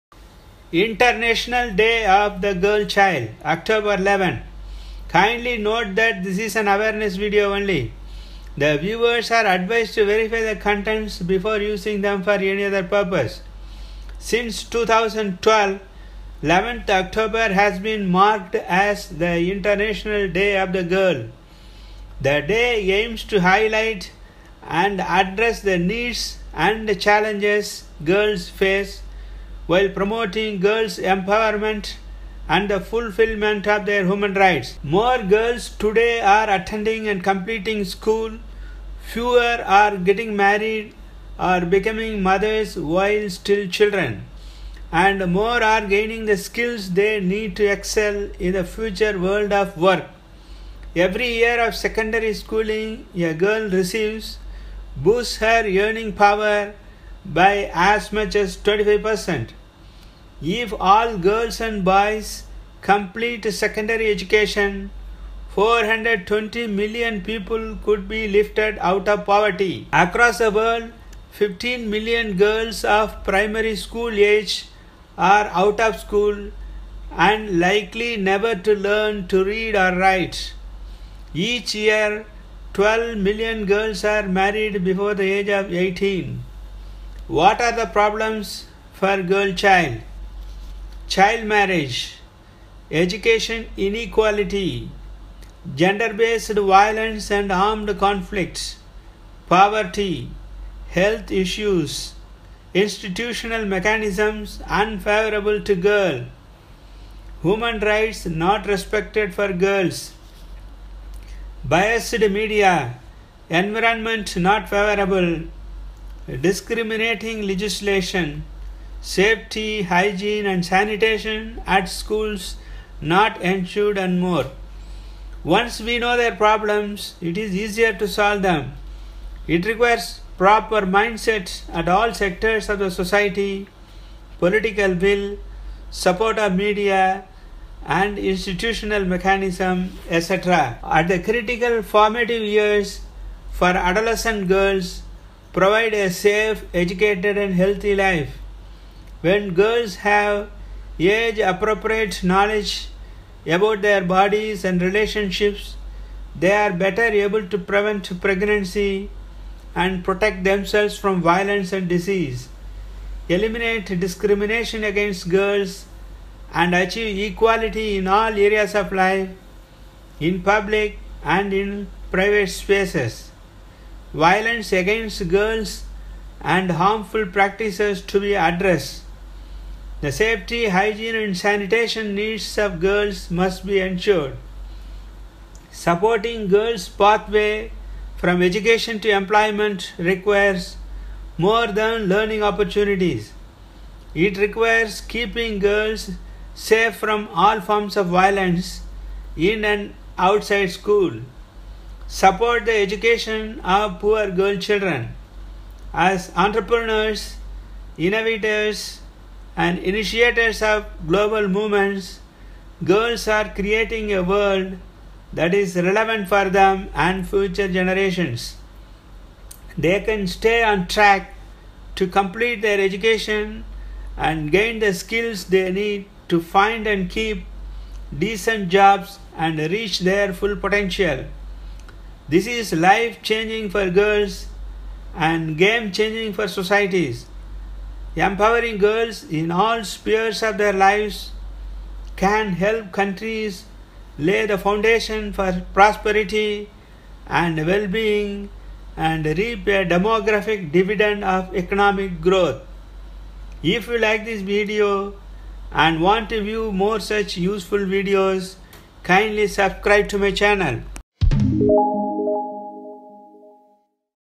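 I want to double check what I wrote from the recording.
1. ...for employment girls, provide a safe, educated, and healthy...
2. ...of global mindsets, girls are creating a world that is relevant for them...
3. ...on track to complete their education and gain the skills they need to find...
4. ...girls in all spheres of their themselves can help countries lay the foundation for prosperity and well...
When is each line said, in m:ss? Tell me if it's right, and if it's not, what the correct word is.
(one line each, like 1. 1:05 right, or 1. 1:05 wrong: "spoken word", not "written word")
1. 2:23 wrong: "adolescent", not "employment"
2. 3:30 wrong: "movements", not "mindsets"
3. 3:40 right
4. 3:58 wrong: "lives", not "themselves".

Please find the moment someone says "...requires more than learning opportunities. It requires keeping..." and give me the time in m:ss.
3:09.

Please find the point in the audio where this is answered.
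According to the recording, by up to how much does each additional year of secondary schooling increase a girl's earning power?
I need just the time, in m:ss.
0:58.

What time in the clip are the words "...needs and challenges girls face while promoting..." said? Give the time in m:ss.
0:25.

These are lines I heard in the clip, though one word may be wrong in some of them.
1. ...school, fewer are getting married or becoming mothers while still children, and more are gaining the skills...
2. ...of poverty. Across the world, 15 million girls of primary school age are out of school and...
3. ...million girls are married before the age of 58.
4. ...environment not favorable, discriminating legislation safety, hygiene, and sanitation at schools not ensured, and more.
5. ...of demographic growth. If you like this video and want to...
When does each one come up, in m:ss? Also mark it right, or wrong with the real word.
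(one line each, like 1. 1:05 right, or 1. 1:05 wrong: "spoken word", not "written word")
1. 0:37 right
2. 1:09 right
3. 1:23 wrong: "18", not "58"
4. 1:53 right
5. 4:11 wrong: "economic", not "demographic".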